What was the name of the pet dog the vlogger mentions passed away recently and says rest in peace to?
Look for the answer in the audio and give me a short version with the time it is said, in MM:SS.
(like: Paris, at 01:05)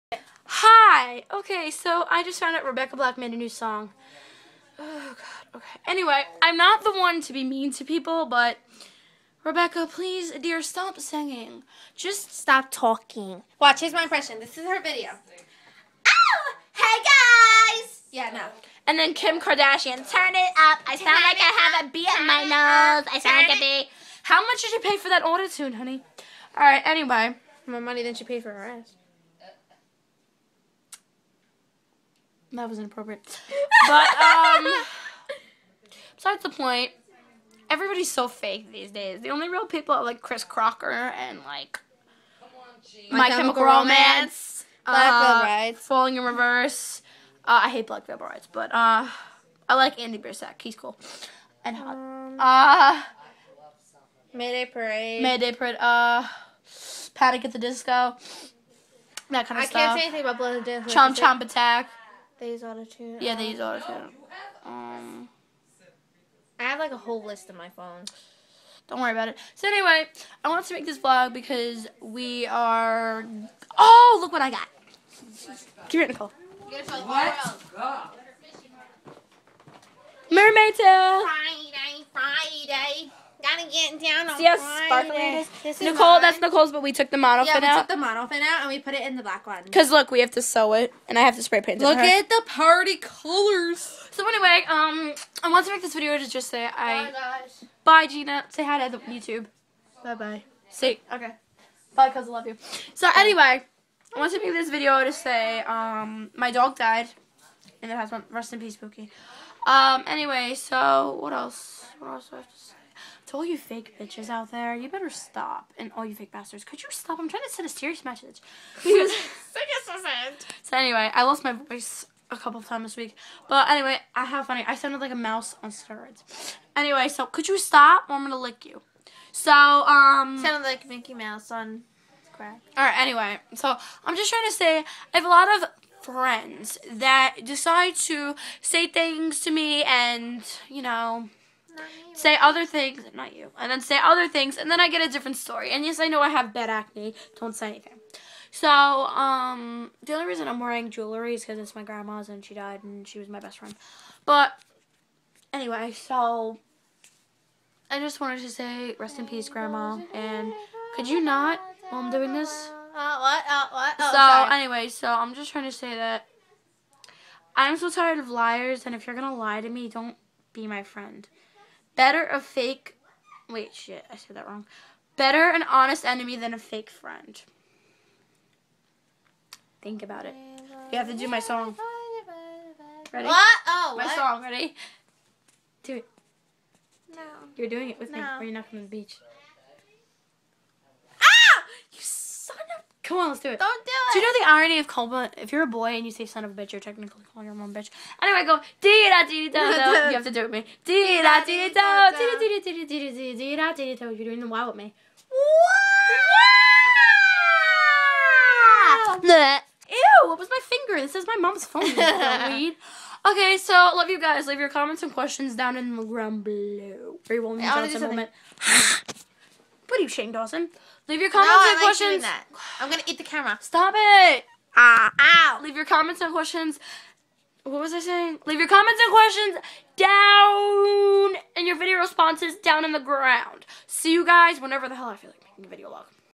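Pookie, at 01:48.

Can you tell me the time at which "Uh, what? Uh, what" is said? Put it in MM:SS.
02:42.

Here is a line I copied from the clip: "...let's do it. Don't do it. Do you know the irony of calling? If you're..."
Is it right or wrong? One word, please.
right.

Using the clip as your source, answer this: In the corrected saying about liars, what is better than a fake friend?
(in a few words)
An honest enemy.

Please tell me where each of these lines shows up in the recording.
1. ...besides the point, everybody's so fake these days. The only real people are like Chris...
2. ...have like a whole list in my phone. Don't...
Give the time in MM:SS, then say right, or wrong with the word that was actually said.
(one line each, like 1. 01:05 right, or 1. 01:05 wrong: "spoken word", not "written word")
1. 00:36 right
2. 01:06 right.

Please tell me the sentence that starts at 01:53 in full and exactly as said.
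To all you fake bitches out there, you better stop.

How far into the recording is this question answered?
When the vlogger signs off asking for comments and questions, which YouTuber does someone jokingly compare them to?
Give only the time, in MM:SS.
03:40.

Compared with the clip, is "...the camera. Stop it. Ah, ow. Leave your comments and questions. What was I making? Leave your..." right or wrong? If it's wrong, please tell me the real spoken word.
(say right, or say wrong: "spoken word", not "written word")
wrong: "saying", not "making".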